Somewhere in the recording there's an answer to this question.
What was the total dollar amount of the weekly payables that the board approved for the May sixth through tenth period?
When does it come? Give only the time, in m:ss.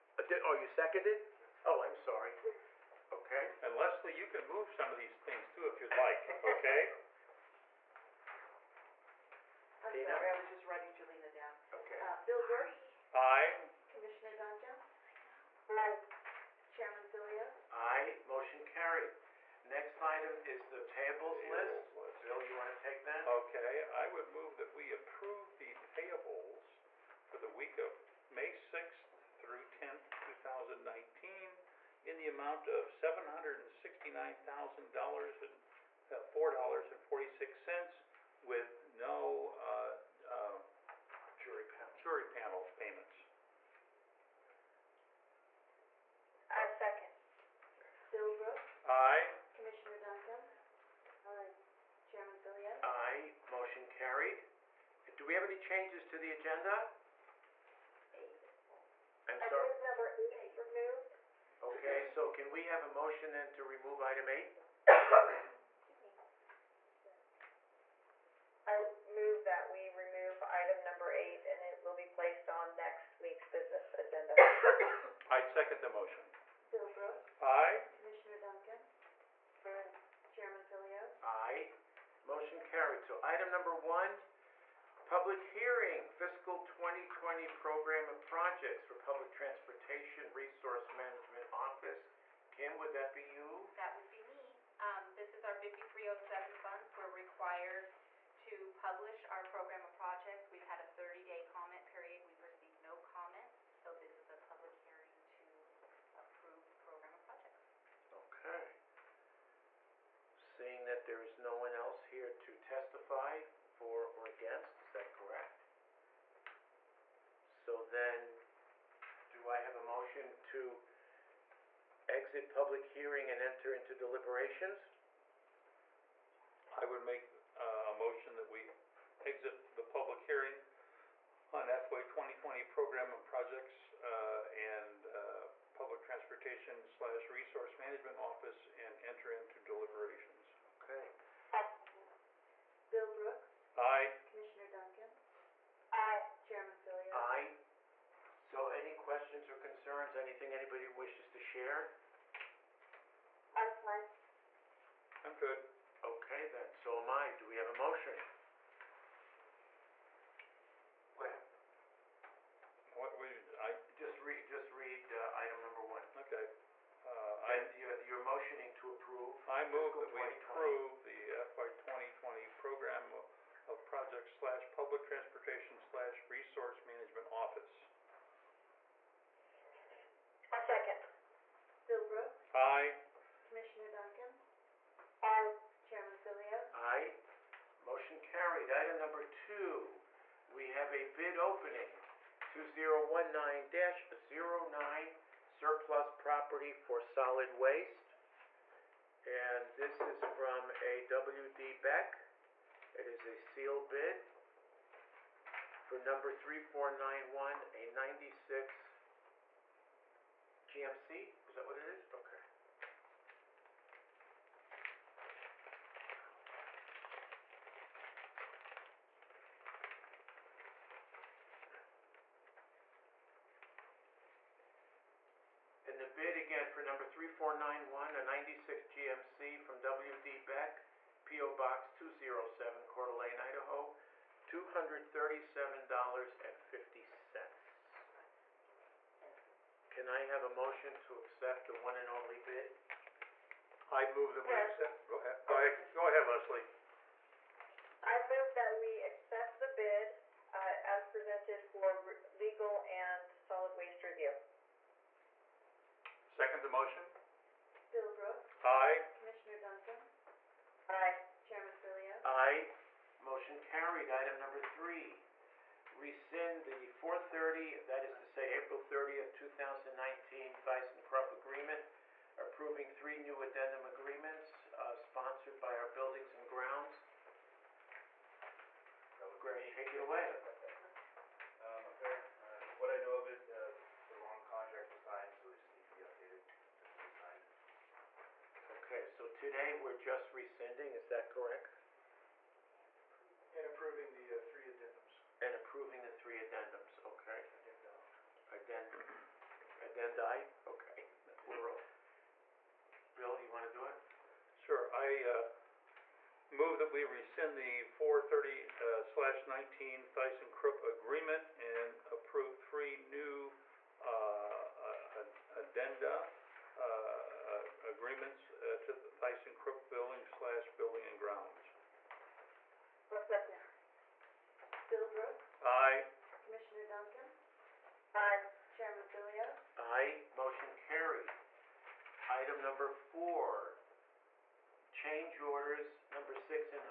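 0:32.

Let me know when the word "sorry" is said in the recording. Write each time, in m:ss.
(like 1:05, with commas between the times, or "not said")
0:01, 0:09, 0:59.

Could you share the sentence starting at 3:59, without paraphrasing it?
Can I have a motion to accept the one and only bid?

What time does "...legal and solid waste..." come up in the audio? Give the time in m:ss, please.
4:12.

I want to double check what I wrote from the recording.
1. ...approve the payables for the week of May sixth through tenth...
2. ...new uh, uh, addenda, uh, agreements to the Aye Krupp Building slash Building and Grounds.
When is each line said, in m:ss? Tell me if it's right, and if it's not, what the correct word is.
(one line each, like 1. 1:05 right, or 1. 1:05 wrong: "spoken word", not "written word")
1. 0:24 right
2. 5:13 wrong: "Thyssen", not "Aye".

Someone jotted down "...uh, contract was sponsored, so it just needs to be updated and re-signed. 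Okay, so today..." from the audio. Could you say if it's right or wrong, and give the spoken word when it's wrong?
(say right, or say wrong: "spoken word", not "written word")
wrong: "signed", not "sponsored".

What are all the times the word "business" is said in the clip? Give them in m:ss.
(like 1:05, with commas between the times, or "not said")
1:13.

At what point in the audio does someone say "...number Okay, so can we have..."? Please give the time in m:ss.
0:59.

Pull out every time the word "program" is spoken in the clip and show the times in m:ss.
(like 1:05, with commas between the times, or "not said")
1:27, 1:39, 1:46, 2:12, 2:52.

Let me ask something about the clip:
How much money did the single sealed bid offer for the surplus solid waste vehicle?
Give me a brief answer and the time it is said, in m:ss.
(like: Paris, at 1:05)
$237.50, at 3:54.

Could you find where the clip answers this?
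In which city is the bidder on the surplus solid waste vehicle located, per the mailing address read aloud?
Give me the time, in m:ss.
3:52.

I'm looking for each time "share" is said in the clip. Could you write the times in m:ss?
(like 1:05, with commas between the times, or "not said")
2:31.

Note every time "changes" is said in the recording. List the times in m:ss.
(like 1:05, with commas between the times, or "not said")
0:55, 5:34.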